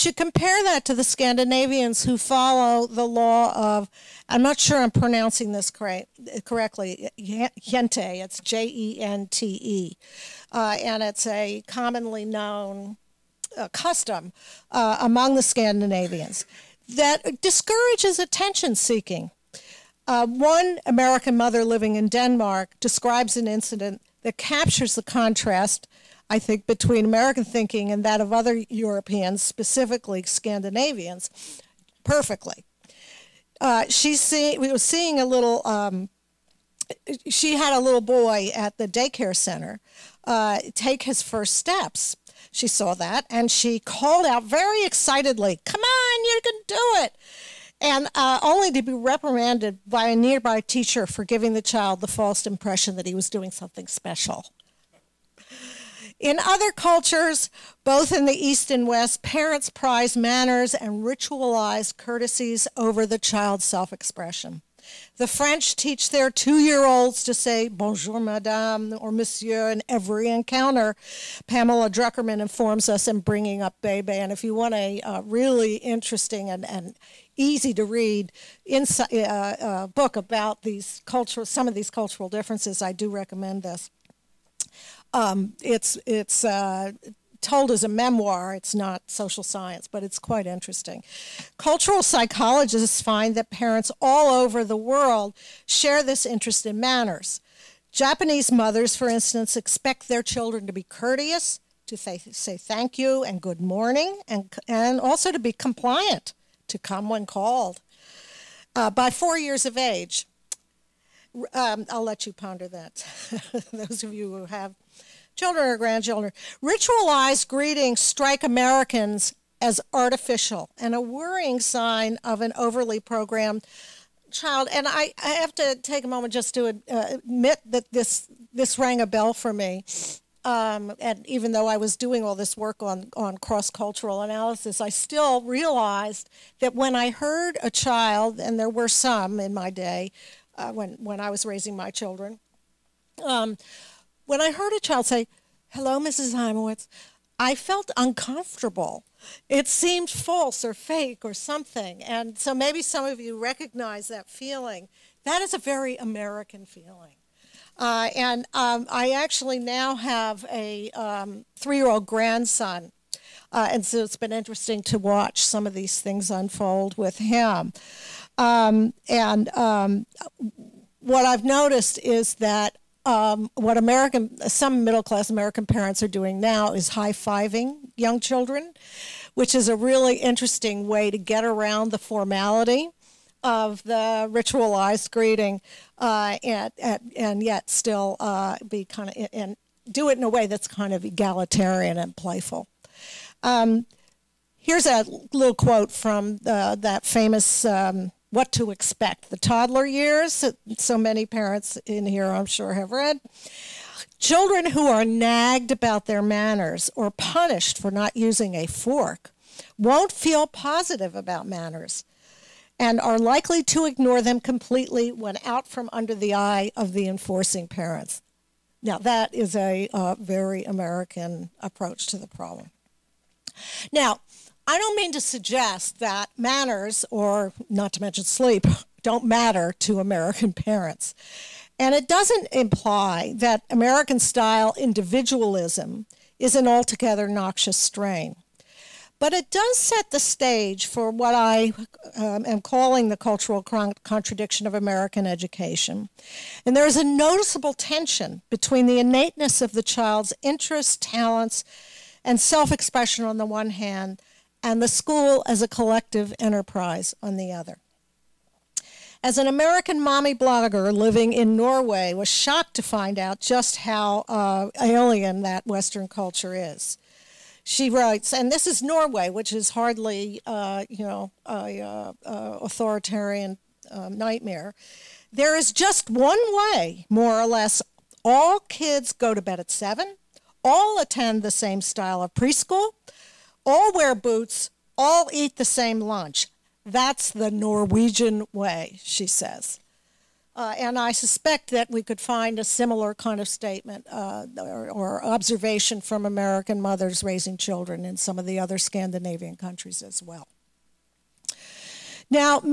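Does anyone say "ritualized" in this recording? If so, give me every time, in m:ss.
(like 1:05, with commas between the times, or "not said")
1:01, 1:56, 3:04.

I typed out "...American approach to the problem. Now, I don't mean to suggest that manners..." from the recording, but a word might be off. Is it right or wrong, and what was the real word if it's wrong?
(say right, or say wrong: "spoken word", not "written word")
right.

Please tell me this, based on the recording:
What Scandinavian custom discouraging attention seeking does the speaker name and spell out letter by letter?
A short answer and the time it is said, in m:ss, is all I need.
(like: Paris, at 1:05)
Jente, at 0:07.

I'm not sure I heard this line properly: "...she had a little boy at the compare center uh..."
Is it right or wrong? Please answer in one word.
wrong.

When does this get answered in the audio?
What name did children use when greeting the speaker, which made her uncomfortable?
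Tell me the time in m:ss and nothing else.
2:25.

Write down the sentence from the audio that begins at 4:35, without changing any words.
There is just one way, more or less.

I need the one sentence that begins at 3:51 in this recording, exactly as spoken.
And it doesn't imply that American style individualism is an altogether noxious strain.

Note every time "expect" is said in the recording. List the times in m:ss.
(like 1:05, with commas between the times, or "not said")
1:39, 3:18.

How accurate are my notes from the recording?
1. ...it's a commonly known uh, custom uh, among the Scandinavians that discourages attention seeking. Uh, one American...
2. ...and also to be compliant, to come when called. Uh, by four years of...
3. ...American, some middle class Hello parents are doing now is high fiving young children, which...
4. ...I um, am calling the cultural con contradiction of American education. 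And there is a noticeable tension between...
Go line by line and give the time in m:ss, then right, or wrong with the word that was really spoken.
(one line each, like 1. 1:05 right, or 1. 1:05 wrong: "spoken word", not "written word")
1. 0:11 right
2. 1:44 right
3. 2:53 wrong: "American", not "Hello"
4. 4:01 right.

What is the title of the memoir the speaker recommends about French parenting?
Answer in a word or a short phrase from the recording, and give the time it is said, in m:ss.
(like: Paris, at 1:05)
Bringing Up Bebe, at 1:13.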